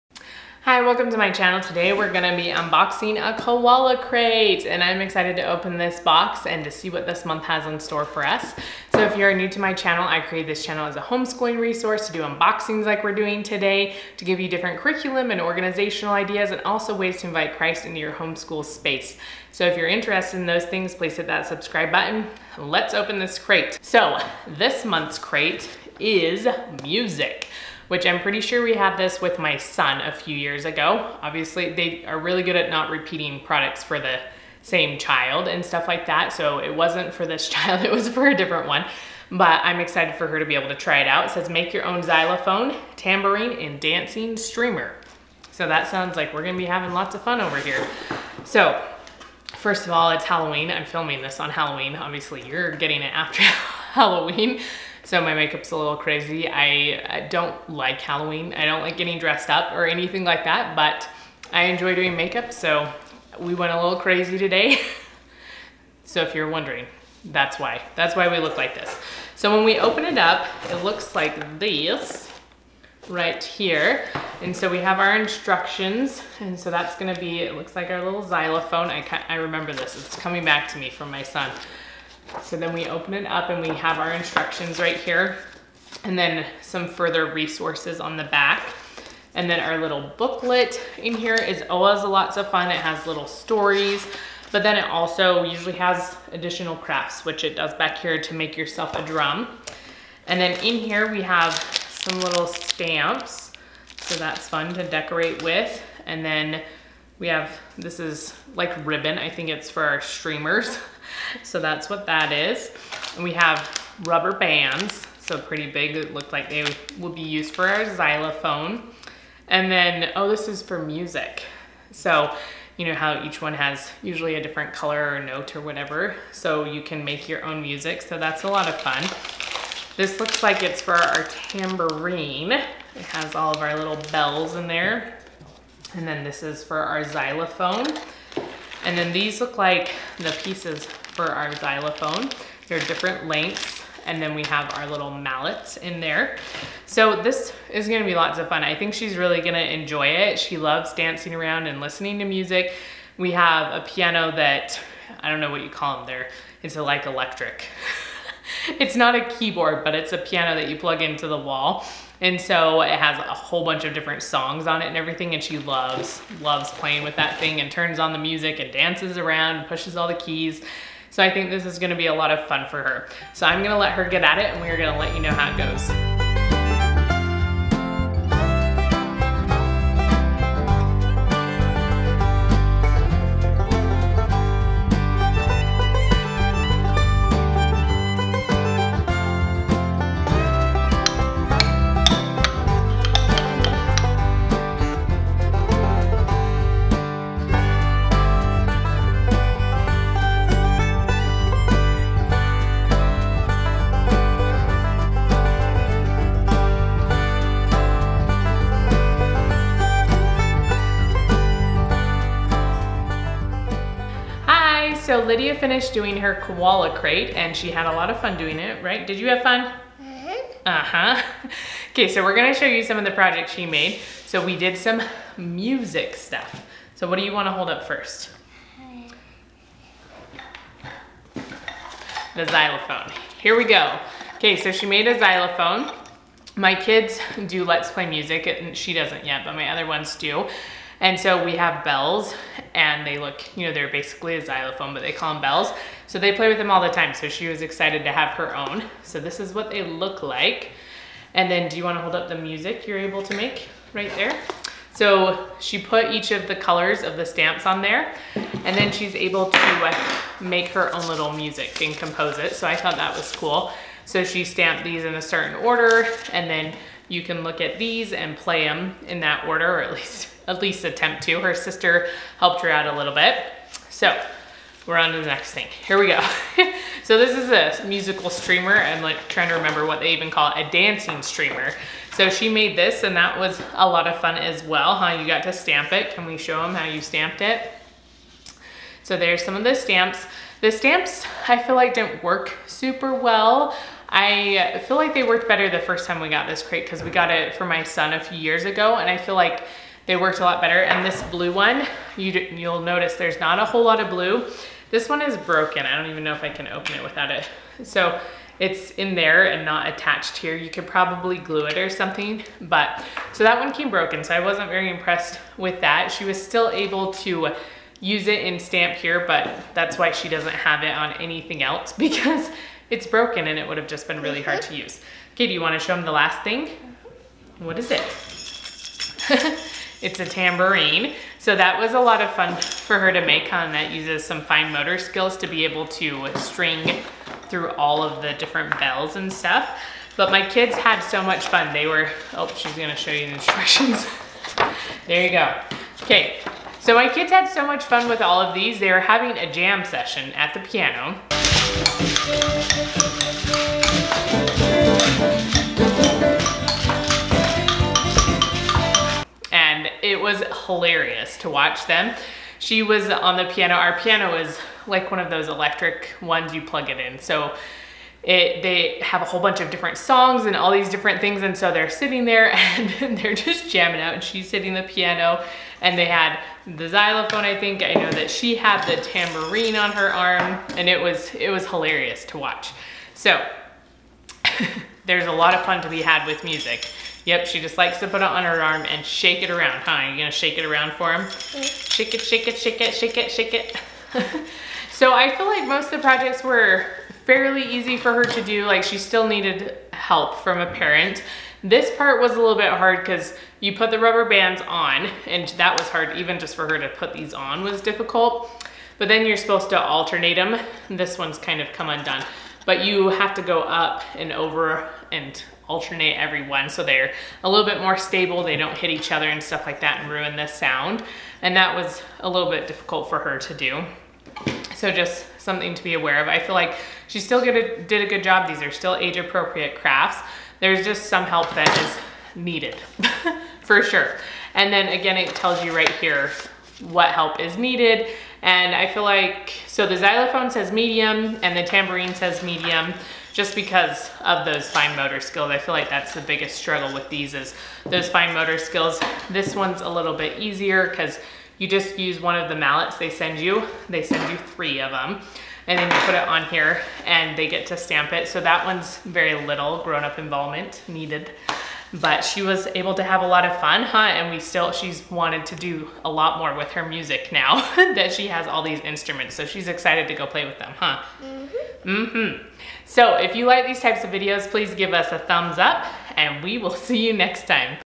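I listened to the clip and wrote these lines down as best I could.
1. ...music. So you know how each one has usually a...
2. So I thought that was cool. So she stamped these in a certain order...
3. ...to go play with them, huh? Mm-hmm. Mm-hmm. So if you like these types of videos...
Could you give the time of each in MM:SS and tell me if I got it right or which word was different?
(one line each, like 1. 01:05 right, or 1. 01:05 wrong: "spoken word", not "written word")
1. 02:00 right
2. 04:22 right
3. 07:50 right.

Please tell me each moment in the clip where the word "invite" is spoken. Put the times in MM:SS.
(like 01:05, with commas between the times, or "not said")
00:17.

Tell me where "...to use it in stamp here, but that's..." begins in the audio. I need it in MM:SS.
05:17.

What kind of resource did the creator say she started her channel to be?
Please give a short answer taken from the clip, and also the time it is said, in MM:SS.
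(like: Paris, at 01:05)
Homeschooling resource, at 00:11.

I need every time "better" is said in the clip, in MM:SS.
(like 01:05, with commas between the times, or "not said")
04:55, 05:00.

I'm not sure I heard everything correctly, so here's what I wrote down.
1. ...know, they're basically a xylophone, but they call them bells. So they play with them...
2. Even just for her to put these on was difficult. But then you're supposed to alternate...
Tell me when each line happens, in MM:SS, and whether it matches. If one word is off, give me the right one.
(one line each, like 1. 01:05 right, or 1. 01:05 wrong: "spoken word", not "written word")
1. 04:03 right
2. 06:46 right.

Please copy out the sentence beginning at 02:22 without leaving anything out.
There are different lengths and then we have our little mallets in there.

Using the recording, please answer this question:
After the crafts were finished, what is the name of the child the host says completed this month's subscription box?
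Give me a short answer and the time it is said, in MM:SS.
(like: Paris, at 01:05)
Lydia, at 03:35.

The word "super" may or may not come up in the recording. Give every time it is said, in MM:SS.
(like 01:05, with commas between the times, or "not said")
04:52.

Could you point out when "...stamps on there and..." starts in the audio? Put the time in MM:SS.
04:17.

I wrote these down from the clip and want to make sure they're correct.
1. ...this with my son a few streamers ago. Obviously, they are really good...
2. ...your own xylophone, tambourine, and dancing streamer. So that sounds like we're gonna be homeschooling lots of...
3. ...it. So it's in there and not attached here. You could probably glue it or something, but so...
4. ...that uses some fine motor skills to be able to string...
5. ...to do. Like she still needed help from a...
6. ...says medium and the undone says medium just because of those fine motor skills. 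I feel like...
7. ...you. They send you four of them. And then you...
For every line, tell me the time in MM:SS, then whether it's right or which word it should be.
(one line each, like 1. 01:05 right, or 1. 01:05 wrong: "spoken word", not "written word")
1. 00:28 wrong: "years", not "streamers"
2. 00:41 wrong: "having", not "homeschooling"
3. 05:07 right
4. 05:33 right
5. 06:38 right
6. 07:20 wrong: "tambourine", not "undone"
7. 07:33 wrong: "three", not "four".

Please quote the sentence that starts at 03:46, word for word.
So what do you wanna hold up first?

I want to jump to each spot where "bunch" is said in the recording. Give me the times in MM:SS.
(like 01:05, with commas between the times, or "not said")
02:43, 06:09.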